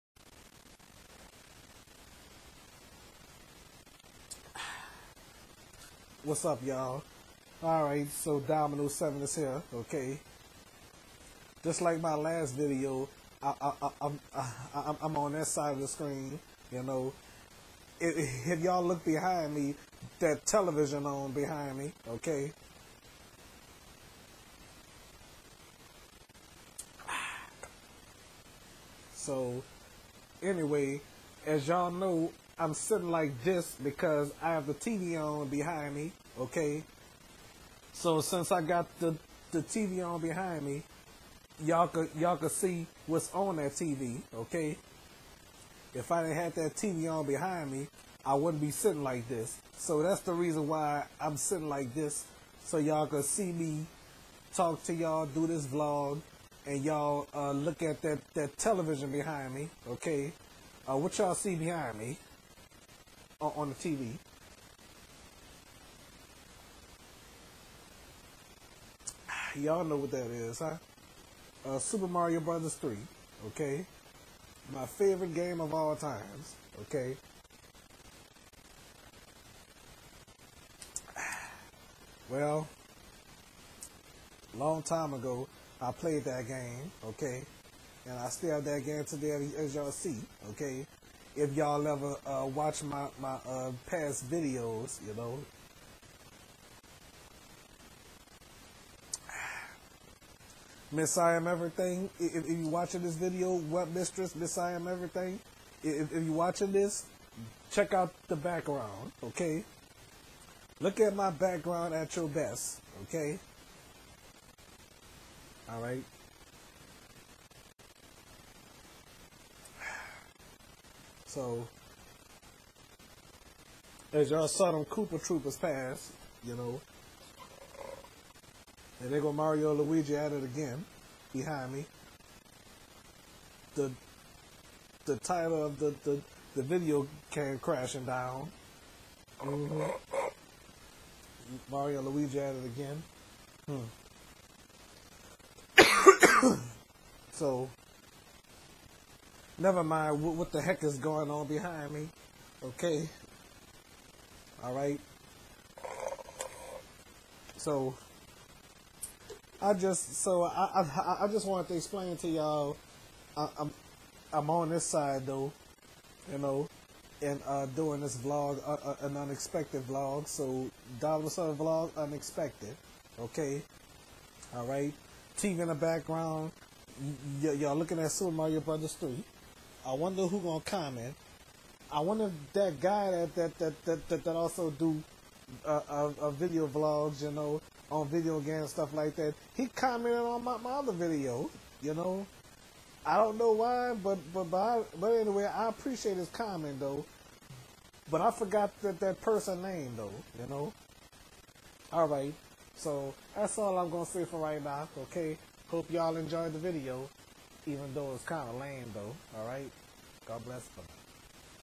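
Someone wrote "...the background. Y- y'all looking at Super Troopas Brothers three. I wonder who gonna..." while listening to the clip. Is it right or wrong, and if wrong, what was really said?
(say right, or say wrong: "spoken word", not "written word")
wrong: "Mario", not "Troopas".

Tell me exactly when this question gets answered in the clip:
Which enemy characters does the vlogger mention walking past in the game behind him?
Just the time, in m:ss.
2:04.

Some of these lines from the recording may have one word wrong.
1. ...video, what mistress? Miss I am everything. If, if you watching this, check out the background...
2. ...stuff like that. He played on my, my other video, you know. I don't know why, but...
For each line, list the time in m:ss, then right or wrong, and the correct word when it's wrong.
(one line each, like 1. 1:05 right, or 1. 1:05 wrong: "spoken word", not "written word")
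1. 1:43 right
2. 3:08 wrong: "commented", not "played".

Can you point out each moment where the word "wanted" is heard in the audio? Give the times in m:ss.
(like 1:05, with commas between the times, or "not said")
2:41.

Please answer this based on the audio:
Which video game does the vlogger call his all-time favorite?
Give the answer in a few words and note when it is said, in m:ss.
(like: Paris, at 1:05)
Super Mario Brothers 3, at 1:11.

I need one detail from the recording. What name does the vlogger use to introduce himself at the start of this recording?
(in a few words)
Domino7.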